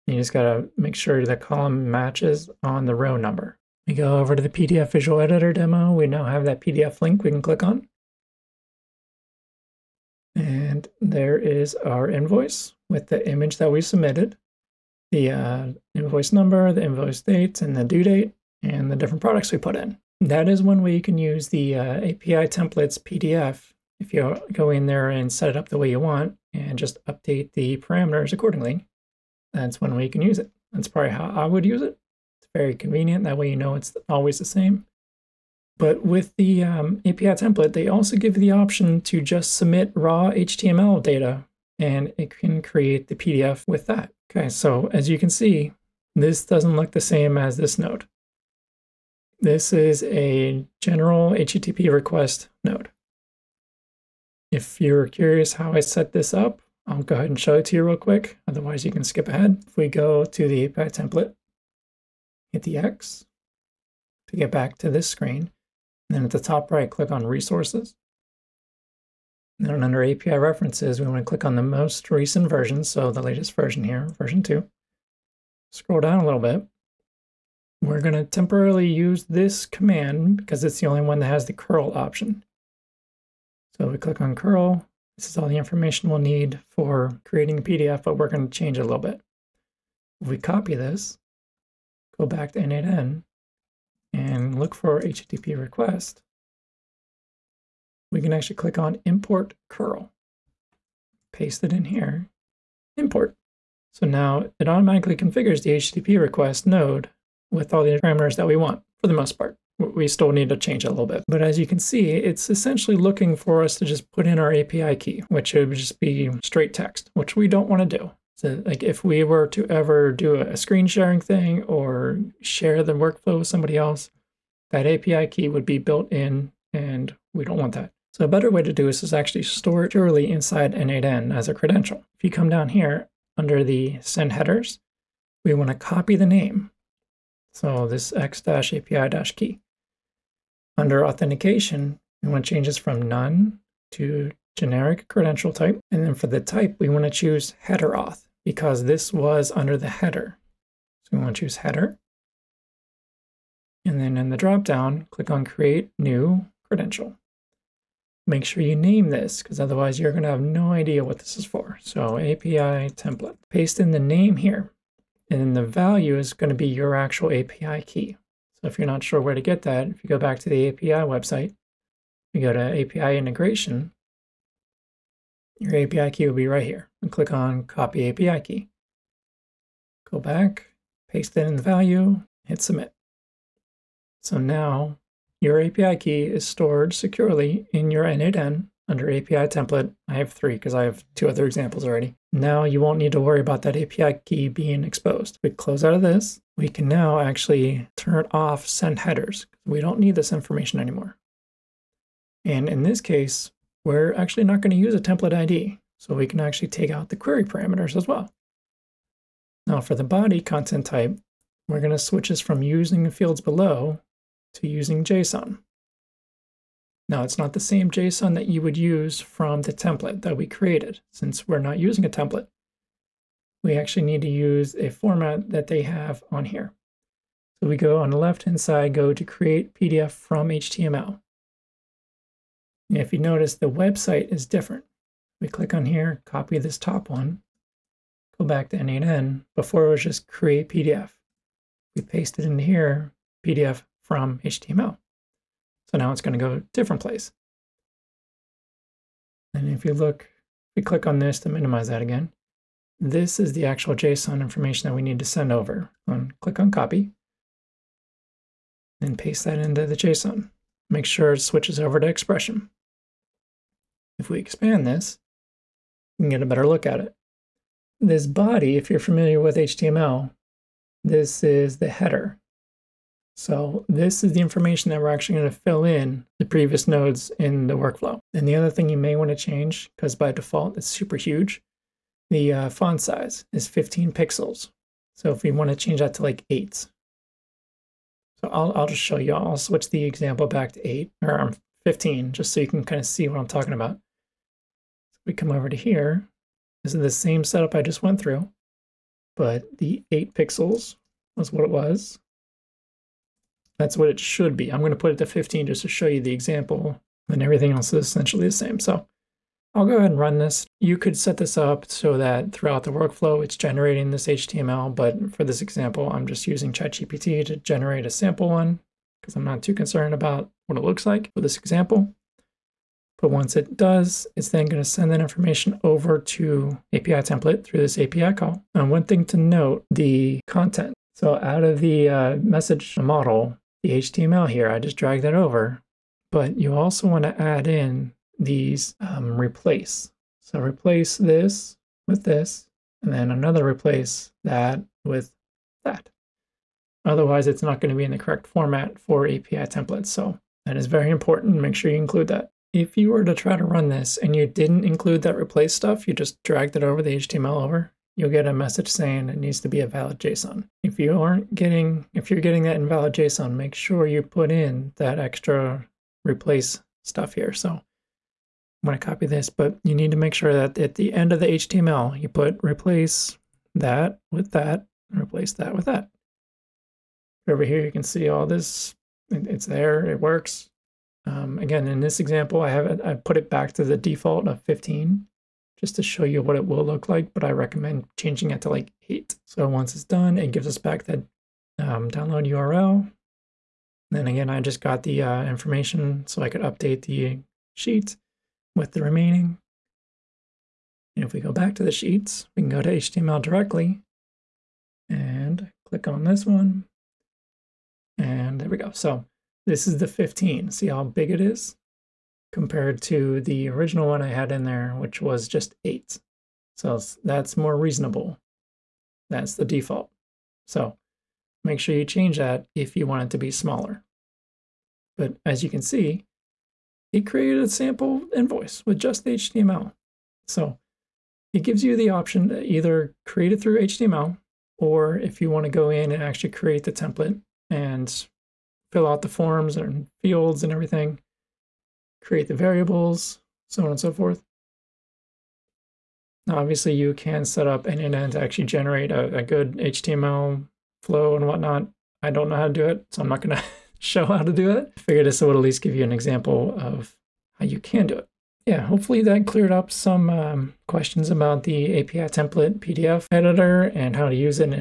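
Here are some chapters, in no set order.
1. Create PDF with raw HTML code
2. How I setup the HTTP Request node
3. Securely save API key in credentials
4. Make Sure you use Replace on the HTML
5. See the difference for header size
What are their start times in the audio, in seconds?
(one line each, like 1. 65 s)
1. 34 s
2. 59 s
3. 111 s
4. 328 s
5. 400 s.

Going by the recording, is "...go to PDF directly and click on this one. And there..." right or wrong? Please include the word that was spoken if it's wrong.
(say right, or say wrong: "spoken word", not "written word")
wrong: "HTML", not "PDF".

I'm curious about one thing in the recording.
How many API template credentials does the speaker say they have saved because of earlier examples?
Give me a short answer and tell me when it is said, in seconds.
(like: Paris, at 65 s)
3, at 190 s.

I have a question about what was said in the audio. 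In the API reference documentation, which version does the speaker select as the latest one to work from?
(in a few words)
version 2.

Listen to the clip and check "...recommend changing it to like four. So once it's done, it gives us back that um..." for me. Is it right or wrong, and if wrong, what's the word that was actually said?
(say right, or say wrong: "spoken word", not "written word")
wrong: "eight", not "four".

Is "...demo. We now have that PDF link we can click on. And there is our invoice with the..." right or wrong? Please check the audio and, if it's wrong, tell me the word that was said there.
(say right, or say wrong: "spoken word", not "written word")
right.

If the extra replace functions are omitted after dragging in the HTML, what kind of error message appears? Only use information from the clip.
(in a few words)
invalid JSON.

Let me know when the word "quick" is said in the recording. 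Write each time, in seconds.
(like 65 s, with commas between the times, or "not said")
57 s.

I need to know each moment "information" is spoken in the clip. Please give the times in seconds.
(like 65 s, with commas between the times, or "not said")
85 s, 200 s, 254 s, 274 s, 325 s, 395 s.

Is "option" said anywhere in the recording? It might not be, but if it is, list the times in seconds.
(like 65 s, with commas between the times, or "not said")
38 s, 81 s, 432 s.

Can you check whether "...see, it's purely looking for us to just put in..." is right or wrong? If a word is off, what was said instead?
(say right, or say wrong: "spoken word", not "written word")
wrong: "essentially", not "purely".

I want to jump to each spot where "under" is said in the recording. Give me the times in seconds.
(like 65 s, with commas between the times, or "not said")
69 s, 133 s, 140 s, 149 s, 188 s.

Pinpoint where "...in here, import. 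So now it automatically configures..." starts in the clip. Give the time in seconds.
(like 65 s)
101 s.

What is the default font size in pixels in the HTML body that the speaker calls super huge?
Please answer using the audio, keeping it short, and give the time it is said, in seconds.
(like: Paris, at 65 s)
15, at 283 s.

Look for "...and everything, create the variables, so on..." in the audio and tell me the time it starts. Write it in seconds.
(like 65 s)
440 s.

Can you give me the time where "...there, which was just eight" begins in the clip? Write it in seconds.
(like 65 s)
414 s.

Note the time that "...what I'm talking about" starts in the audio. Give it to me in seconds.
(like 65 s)
293 s.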